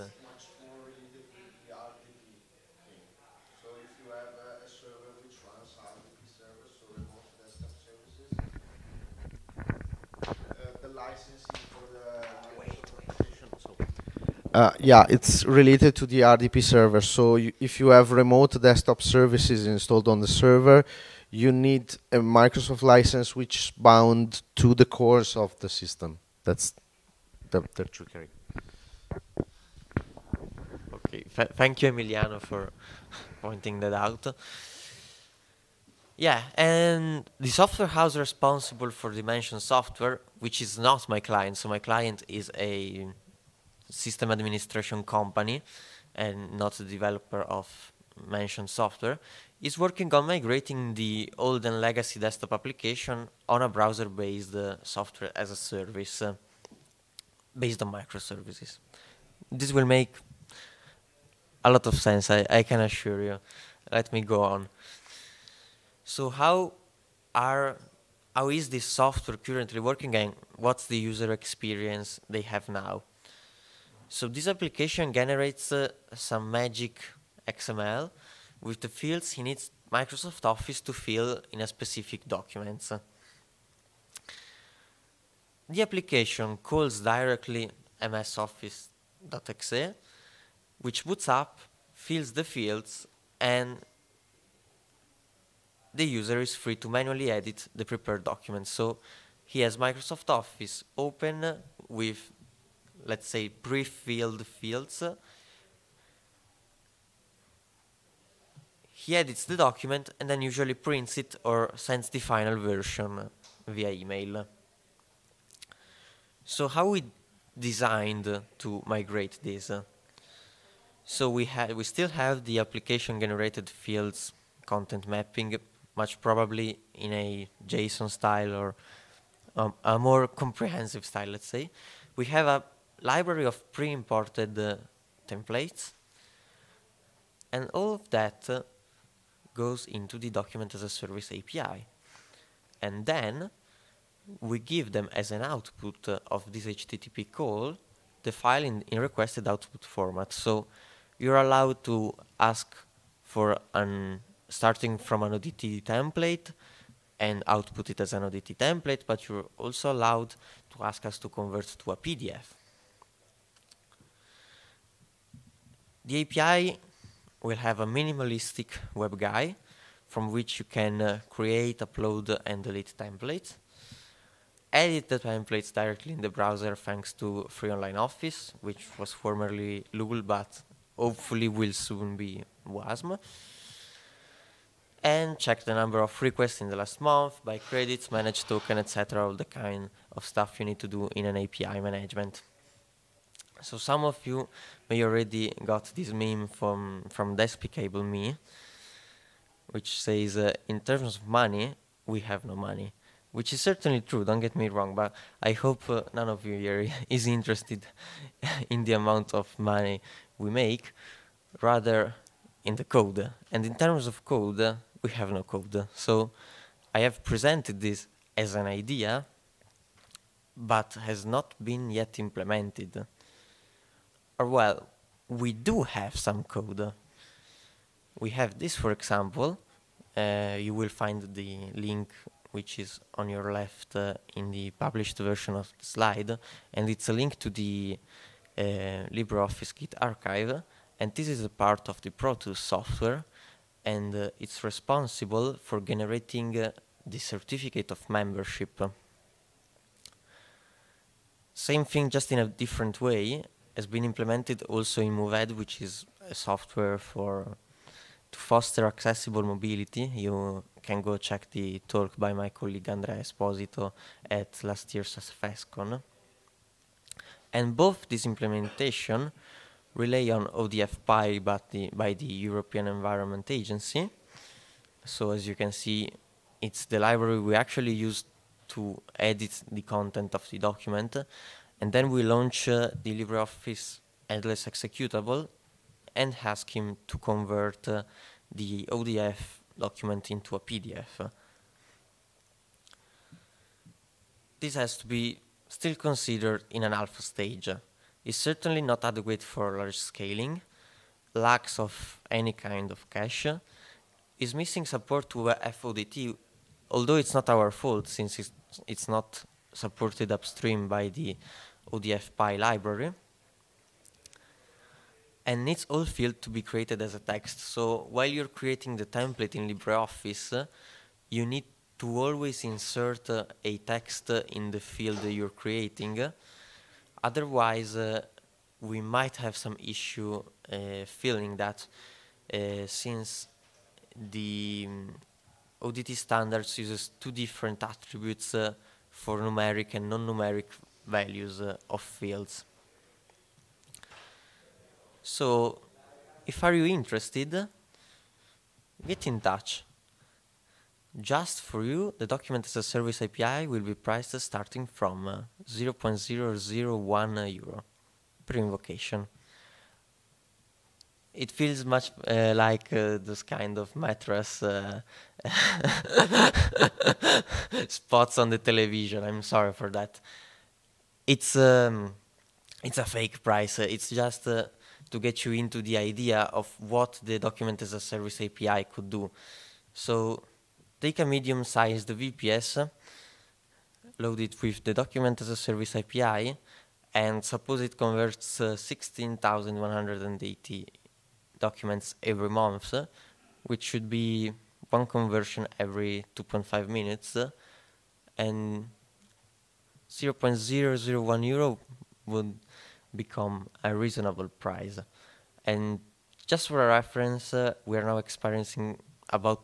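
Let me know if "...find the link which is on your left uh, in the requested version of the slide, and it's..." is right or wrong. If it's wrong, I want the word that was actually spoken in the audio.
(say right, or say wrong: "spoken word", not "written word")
wrong: "published", not "requested".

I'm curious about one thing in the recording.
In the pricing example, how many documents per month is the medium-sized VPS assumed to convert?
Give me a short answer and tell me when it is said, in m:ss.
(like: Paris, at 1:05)
16,180, at 6:28.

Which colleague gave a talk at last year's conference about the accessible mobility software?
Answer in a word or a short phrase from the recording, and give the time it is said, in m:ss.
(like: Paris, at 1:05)
Andrea Esposito, at 4:22.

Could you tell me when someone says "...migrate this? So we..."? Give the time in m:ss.
1:58.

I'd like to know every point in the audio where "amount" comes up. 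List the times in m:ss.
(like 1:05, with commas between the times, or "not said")
3:28.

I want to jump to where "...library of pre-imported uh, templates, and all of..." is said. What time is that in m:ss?
2:13.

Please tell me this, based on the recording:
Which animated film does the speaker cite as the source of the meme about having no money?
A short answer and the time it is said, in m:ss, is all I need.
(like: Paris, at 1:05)
Despicable Me, at 3:17.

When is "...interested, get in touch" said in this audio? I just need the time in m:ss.
5:46.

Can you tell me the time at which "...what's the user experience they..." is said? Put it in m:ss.
1:10.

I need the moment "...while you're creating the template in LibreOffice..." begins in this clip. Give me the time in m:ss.
5:18.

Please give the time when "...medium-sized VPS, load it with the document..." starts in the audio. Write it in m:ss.
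6:21.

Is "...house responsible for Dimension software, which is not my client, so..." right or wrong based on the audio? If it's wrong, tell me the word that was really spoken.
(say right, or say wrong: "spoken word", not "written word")
right.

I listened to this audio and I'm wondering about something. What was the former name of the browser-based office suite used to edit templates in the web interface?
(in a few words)
LOOL.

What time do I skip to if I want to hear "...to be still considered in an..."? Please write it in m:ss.
4:54.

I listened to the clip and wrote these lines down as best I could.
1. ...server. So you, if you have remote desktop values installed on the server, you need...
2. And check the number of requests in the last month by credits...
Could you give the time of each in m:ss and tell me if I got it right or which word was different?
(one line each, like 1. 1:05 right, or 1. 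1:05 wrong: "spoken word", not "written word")
1. 0:16 wrong: "services", not "values"
2. 3:05 right.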